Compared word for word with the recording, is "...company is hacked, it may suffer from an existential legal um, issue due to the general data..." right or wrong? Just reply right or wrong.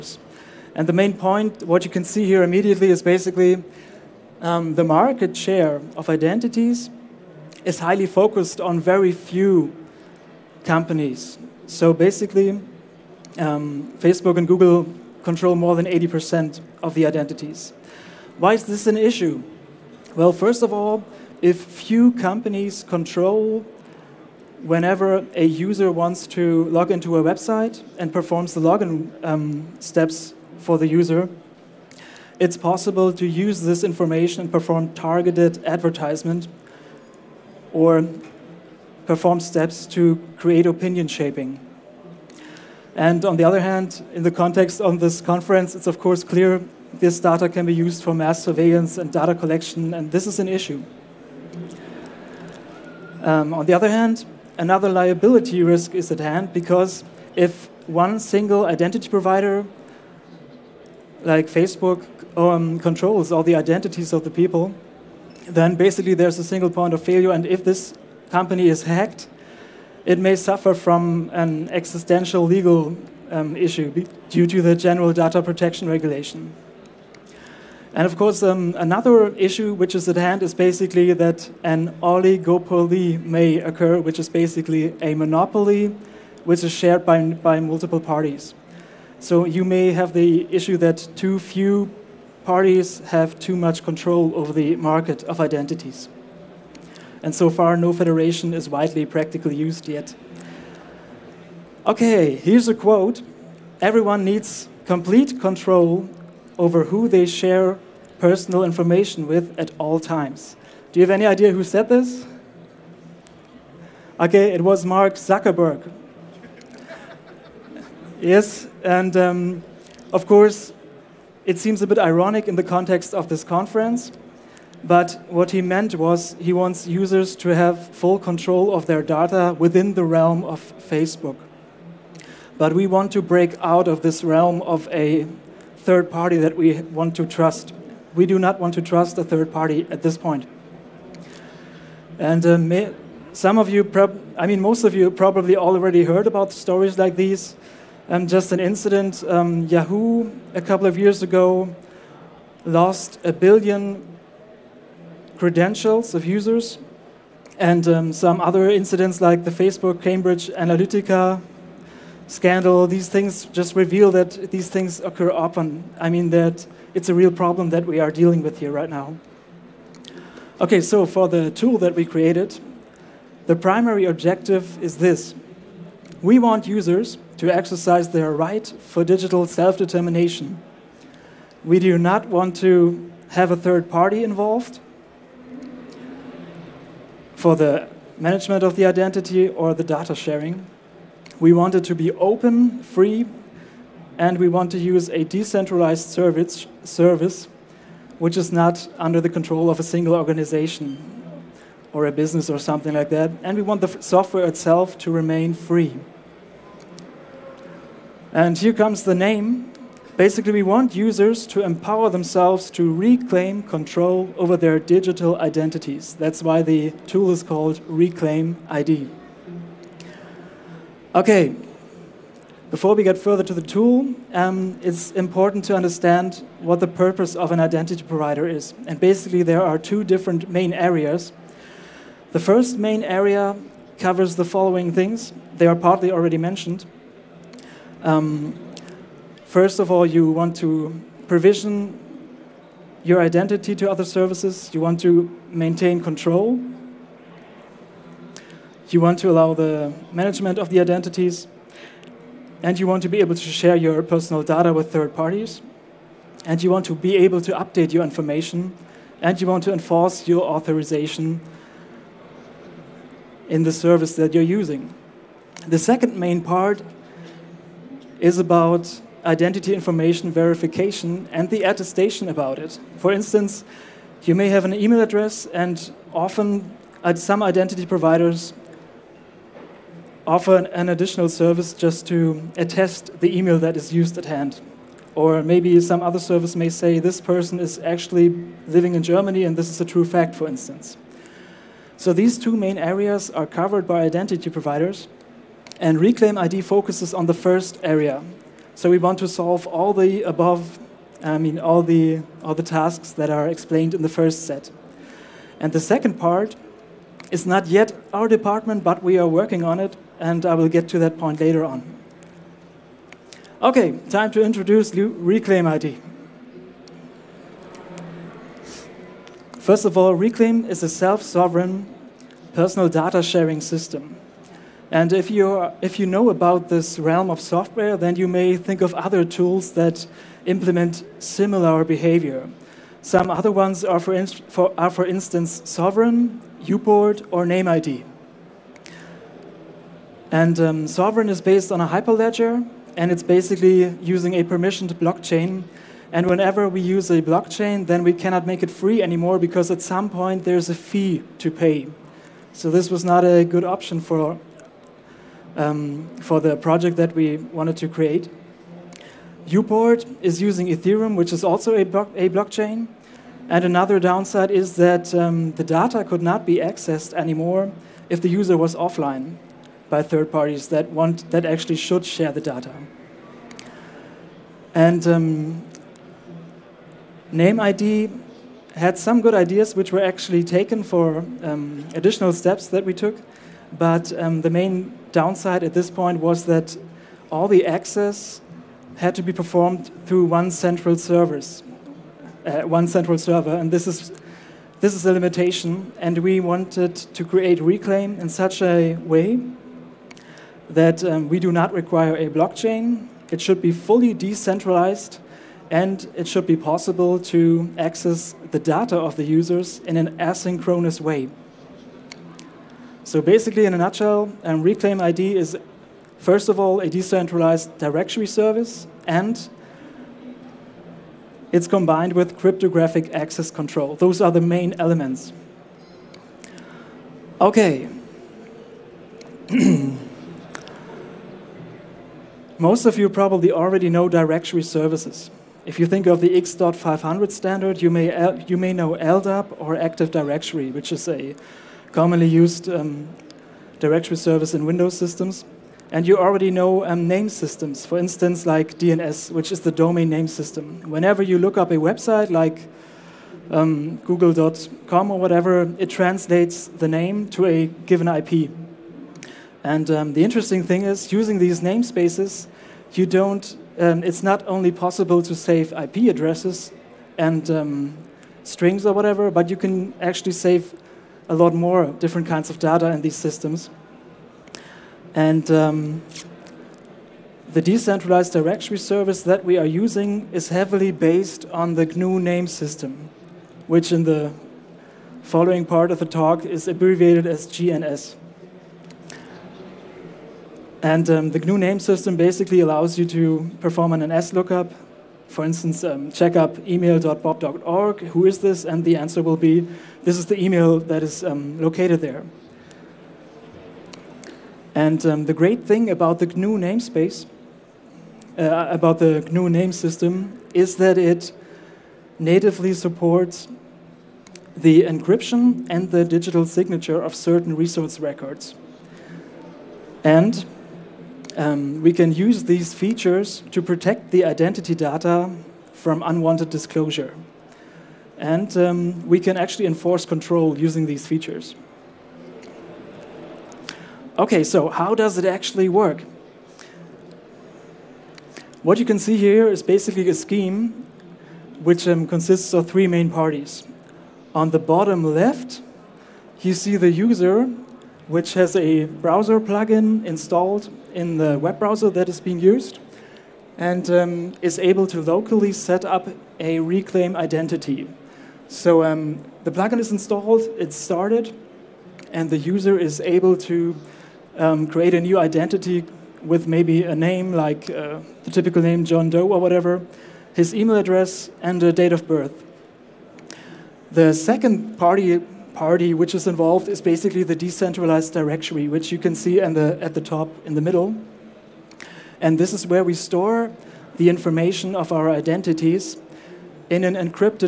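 right.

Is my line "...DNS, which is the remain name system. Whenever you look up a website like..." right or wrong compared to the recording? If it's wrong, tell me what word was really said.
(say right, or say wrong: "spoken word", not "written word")
wrong: "domain", not "remain".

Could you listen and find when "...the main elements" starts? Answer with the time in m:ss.
7:04.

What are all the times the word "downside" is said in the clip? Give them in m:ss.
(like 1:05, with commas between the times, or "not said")
6:03, 6:25.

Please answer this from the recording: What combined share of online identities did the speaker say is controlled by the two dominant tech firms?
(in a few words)
more than 80%.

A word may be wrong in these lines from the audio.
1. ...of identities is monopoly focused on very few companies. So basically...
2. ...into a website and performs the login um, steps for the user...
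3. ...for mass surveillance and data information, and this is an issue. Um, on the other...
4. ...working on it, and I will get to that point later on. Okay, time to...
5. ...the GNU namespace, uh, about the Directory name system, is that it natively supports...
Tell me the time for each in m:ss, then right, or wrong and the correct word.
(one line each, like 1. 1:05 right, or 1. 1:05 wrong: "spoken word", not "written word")
1. 0:05 wrong: "highly", not "monopoly"
2. 0:26 right
3. 0:48 wrong: "collection", not "information"
4. 5:09 right
5. 8:26 wrong: "GNU", not "Directory".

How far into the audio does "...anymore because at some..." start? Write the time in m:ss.
5:49.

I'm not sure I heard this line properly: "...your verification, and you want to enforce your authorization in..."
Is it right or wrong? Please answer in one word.
wrong.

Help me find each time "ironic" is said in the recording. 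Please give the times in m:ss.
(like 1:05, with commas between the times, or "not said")
2:01.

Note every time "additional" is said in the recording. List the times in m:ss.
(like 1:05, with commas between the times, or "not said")
4:40, 6:21.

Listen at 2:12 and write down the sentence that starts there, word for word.
But we want to break out of this realm of a third party that we want to trust.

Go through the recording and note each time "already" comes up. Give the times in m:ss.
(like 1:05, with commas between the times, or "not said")
2:25, 3:56, 7:13, 7:26.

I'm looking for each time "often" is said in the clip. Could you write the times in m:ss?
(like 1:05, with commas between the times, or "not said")
2:45, 4:36.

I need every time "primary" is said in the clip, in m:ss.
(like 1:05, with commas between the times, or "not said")
2:53.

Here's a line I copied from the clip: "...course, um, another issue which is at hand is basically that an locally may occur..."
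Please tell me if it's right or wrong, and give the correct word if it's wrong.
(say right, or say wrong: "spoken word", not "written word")
wrong: "oligopoly", not "locally".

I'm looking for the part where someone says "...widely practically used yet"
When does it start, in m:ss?
1:38.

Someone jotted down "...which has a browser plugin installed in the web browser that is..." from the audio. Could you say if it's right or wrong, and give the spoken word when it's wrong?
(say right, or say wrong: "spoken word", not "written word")
right.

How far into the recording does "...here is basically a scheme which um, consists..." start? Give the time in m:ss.
8:59.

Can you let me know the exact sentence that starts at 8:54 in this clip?
Okay, so how does it actually work?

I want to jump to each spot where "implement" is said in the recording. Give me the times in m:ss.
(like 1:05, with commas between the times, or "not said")
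5:30.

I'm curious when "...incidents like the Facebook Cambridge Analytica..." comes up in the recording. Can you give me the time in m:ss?
2:38.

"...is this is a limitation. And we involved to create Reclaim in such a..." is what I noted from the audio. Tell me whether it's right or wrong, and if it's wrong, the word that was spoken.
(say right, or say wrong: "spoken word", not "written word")
wrong: "wanted", not "involved".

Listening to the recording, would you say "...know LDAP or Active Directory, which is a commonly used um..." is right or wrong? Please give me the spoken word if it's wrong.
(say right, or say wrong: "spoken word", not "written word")
right.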